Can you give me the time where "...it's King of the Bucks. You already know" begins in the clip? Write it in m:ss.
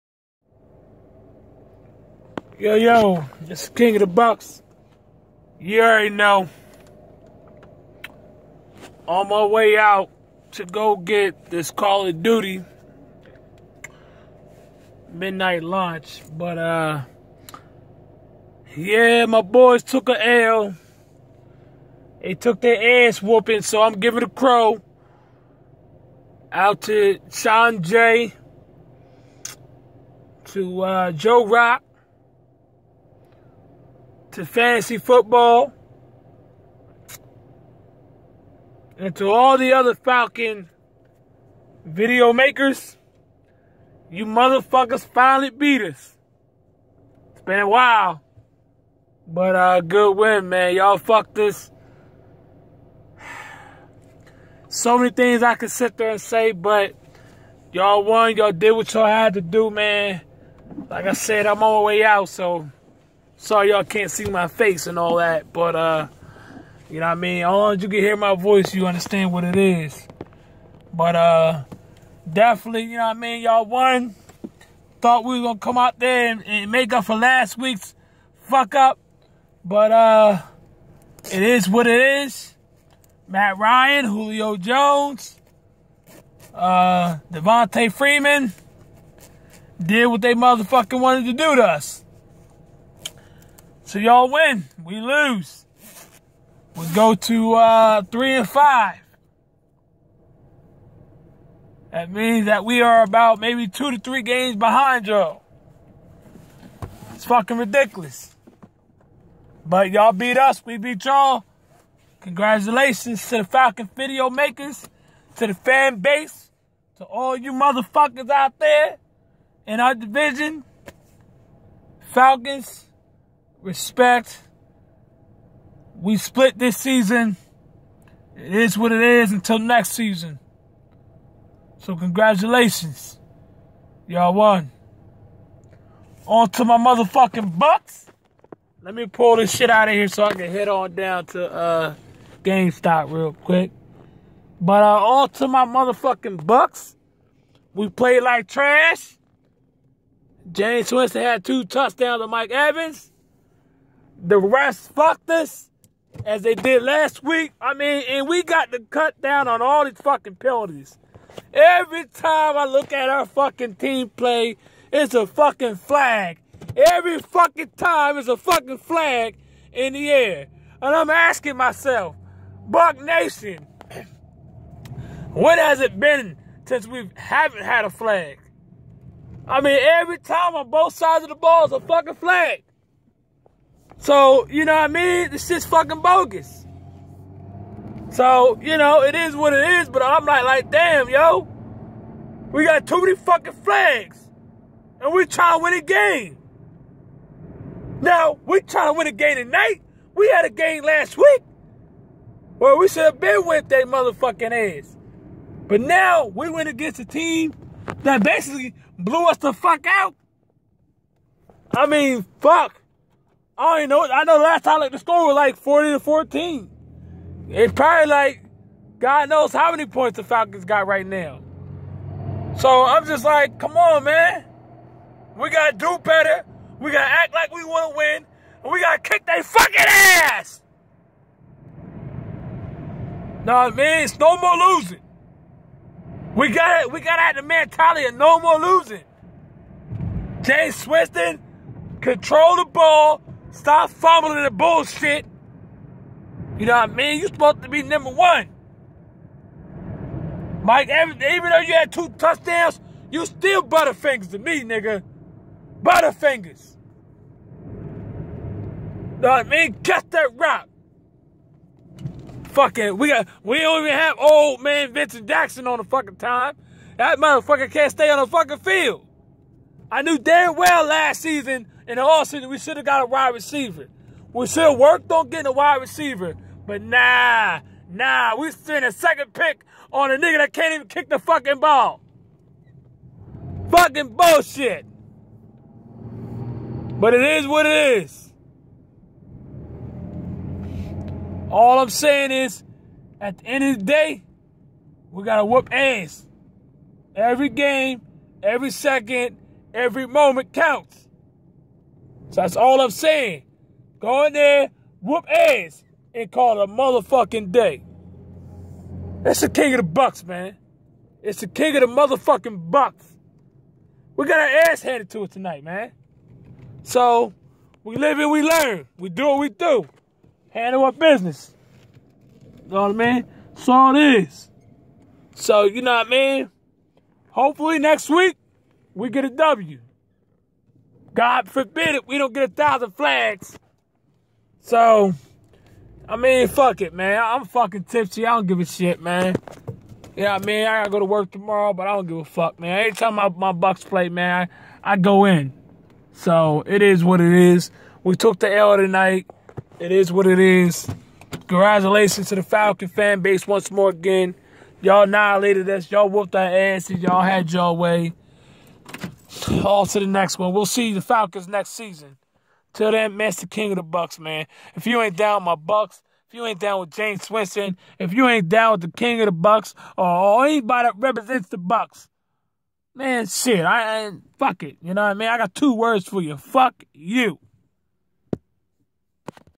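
0:03.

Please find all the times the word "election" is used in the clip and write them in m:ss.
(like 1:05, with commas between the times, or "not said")
not said.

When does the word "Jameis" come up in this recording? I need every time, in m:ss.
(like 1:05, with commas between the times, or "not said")
2:30, 4:00, 6:06.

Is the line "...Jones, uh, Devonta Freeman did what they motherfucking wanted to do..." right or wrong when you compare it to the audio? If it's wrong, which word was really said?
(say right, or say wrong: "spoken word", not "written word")
right.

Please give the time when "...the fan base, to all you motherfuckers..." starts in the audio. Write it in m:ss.
1:55.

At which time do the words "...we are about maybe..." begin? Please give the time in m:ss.
1:42.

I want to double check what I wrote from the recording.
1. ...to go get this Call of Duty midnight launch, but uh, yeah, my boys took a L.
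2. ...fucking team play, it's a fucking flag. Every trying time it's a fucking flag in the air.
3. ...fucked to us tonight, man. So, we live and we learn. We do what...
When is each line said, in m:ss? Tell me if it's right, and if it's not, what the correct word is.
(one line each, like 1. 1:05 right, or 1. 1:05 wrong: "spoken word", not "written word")
1. 0:10 right
2. 2:43 wrong: "fucking", not "trying"
3. 5:14 wrong: "handed", not "fucked".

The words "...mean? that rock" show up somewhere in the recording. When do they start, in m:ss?
4:19.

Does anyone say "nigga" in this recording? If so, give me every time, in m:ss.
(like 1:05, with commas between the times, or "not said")
4:14, 4:40.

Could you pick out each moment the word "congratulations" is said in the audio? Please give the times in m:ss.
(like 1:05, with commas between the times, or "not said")
1:52, 2:11, 5:51.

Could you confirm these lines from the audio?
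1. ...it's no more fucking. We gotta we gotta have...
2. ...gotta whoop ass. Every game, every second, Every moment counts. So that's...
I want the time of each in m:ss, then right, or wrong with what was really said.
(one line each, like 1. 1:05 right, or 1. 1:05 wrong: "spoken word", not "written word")
1. 3:54 wrong: "losing", not "fucking"
2. 4:55 right.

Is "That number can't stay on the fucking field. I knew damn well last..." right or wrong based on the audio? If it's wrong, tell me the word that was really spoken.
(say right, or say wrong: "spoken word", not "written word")
wrong: "motherfucker", not "number".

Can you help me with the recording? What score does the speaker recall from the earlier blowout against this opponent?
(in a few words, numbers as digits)
40 to 14.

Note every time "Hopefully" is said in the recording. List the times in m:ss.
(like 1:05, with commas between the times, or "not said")
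5:27.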